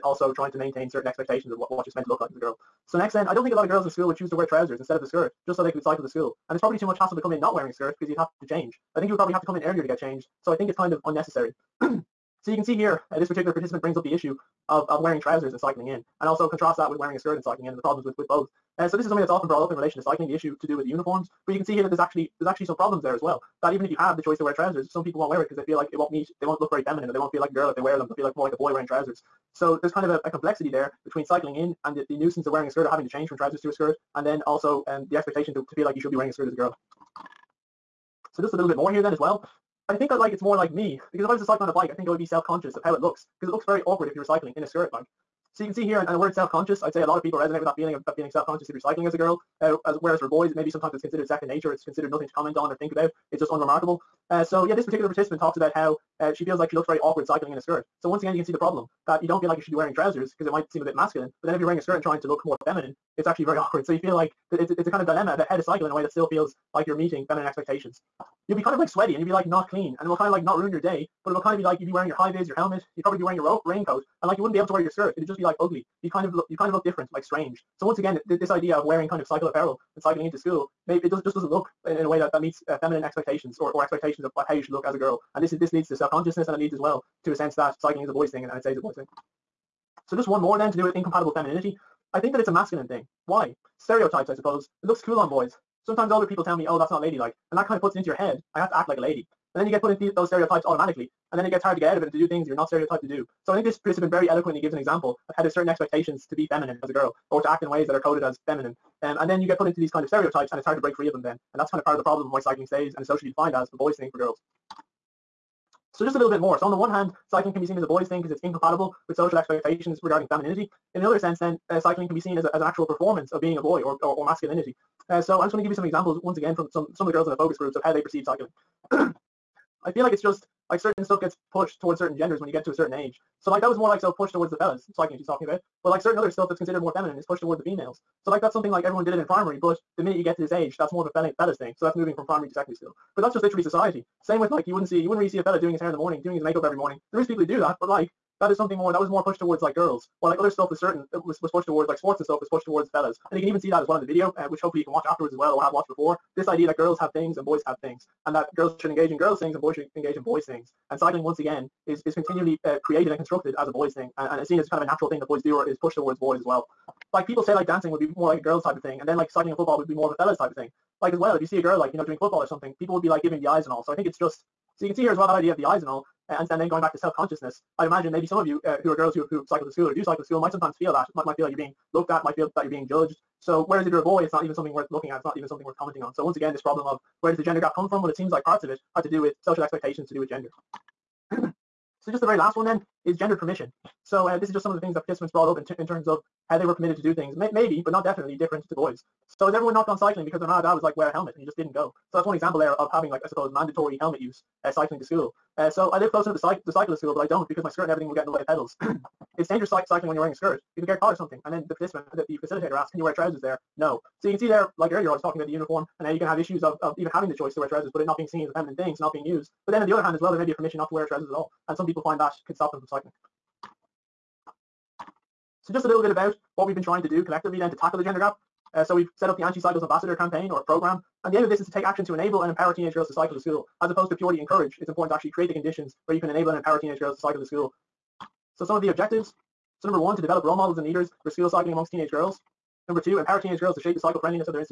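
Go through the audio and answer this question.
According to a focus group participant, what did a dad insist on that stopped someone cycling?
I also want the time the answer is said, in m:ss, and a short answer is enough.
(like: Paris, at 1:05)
wear a helmet, at 3:20.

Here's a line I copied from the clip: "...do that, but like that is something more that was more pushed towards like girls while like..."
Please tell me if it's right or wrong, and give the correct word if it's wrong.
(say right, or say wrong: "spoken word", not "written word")
right.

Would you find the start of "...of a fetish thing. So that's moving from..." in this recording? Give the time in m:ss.
2:21.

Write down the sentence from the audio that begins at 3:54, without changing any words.
It's important to actually create the conditions where you can enable and empower teenage girls to cycle to school.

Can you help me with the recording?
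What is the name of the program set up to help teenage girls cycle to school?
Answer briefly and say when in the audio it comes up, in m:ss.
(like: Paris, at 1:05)
Anti-Cycles Ambassador, at 3:49.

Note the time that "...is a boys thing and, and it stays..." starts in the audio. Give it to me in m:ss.
1:28.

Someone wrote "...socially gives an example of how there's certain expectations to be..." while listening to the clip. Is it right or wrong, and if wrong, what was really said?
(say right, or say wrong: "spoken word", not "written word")
wrong: "eloquently", not "socially".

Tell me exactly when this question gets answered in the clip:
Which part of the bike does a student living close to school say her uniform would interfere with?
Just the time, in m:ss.
3:28.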